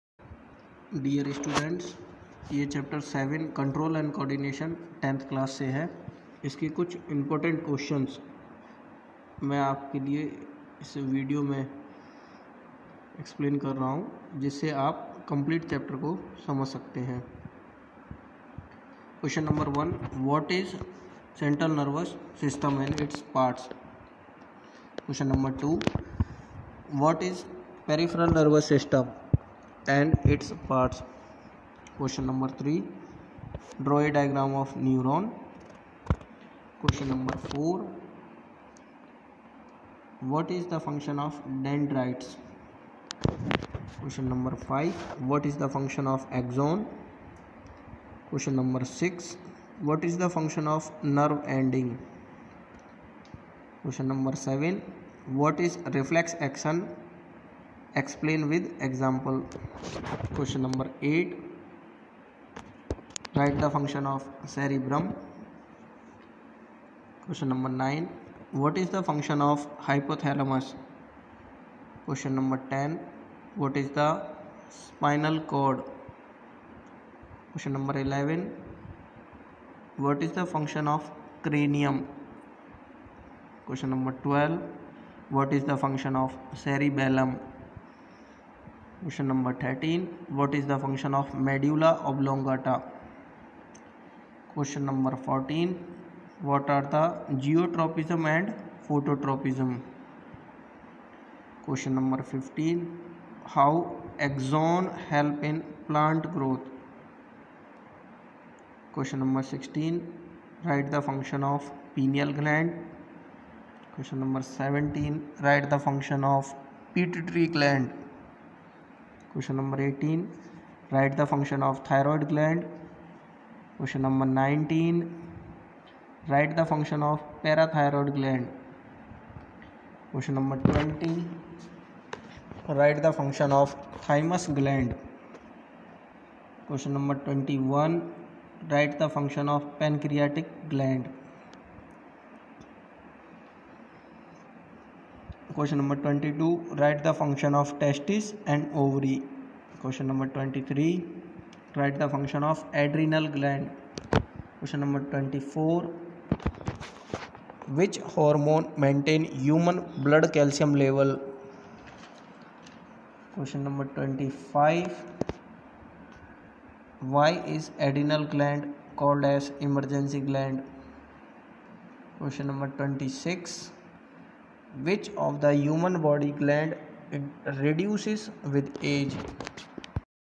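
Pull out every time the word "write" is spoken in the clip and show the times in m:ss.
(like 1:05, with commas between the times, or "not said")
1:03, 2:26, 2:31.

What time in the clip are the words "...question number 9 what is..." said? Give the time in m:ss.
1:07.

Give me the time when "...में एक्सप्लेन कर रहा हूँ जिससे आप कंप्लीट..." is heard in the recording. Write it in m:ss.
0:11.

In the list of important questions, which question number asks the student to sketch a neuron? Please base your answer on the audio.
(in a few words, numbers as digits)
3.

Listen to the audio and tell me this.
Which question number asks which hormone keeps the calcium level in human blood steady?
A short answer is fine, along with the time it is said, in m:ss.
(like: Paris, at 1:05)
24, at 2:34.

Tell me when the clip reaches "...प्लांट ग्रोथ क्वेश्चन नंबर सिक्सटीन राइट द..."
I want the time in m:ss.
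1:45.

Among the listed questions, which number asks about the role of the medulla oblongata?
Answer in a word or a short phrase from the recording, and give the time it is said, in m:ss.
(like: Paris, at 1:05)
13, at 1:29.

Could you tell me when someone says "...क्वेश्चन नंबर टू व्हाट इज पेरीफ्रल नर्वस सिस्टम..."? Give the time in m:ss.
0:25.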